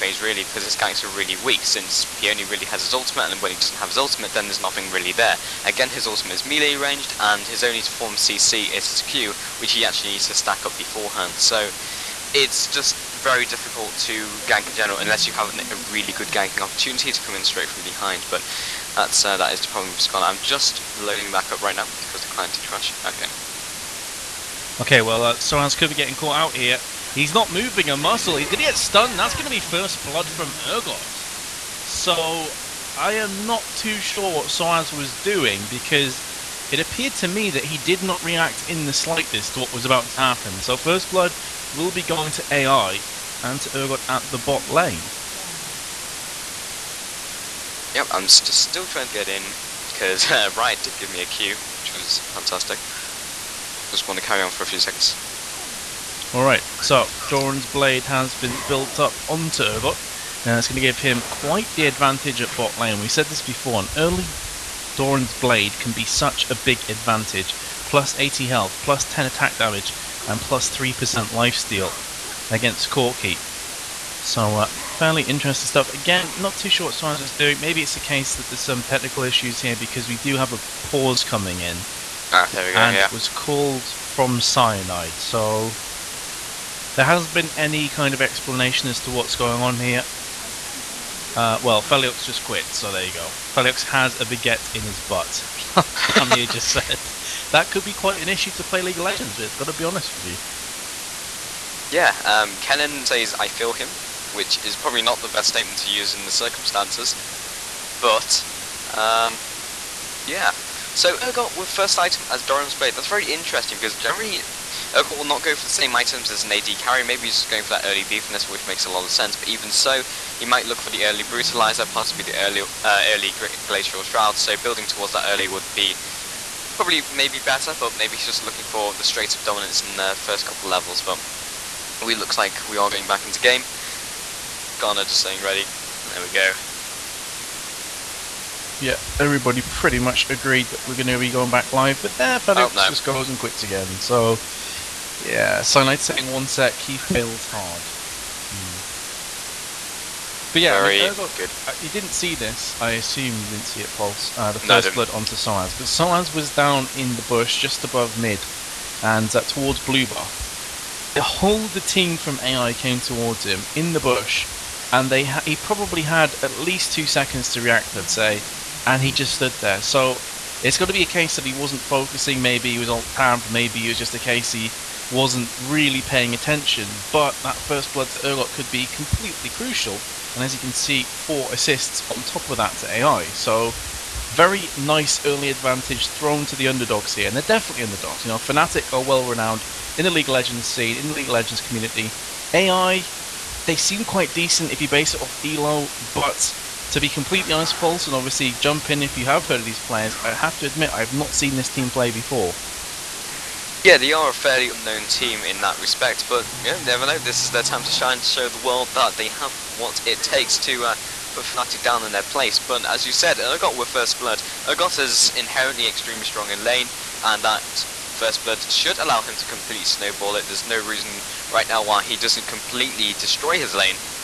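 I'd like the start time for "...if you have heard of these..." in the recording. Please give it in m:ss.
3:19.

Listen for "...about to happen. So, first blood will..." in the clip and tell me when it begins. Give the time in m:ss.
0:39.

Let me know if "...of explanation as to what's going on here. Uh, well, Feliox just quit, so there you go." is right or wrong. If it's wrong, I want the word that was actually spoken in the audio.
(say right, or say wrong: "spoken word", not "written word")
right.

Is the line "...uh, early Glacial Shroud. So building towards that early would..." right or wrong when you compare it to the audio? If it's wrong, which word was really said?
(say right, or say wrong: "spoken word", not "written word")
right.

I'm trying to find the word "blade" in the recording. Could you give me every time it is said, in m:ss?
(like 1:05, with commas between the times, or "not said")
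0:57, 1:05, 1:52.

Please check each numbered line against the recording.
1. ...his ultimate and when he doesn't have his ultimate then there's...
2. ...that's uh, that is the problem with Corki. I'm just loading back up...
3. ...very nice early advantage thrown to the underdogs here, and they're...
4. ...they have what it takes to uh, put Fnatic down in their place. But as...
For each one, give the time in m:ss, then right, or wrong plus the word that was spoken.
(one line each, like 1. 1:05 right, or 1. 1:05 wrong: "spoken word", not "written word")
1. 0:02 right
2. 0:18 wrong: "Scarlet", not "Corki"
3. 3:04 right
4. 3:29 right.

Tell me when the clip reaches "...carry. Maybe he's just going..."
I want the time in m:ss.
1:56.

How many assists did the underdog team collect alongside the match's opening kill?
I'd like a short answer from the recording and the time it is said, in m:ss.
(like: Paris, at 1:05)
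4, at 3:01.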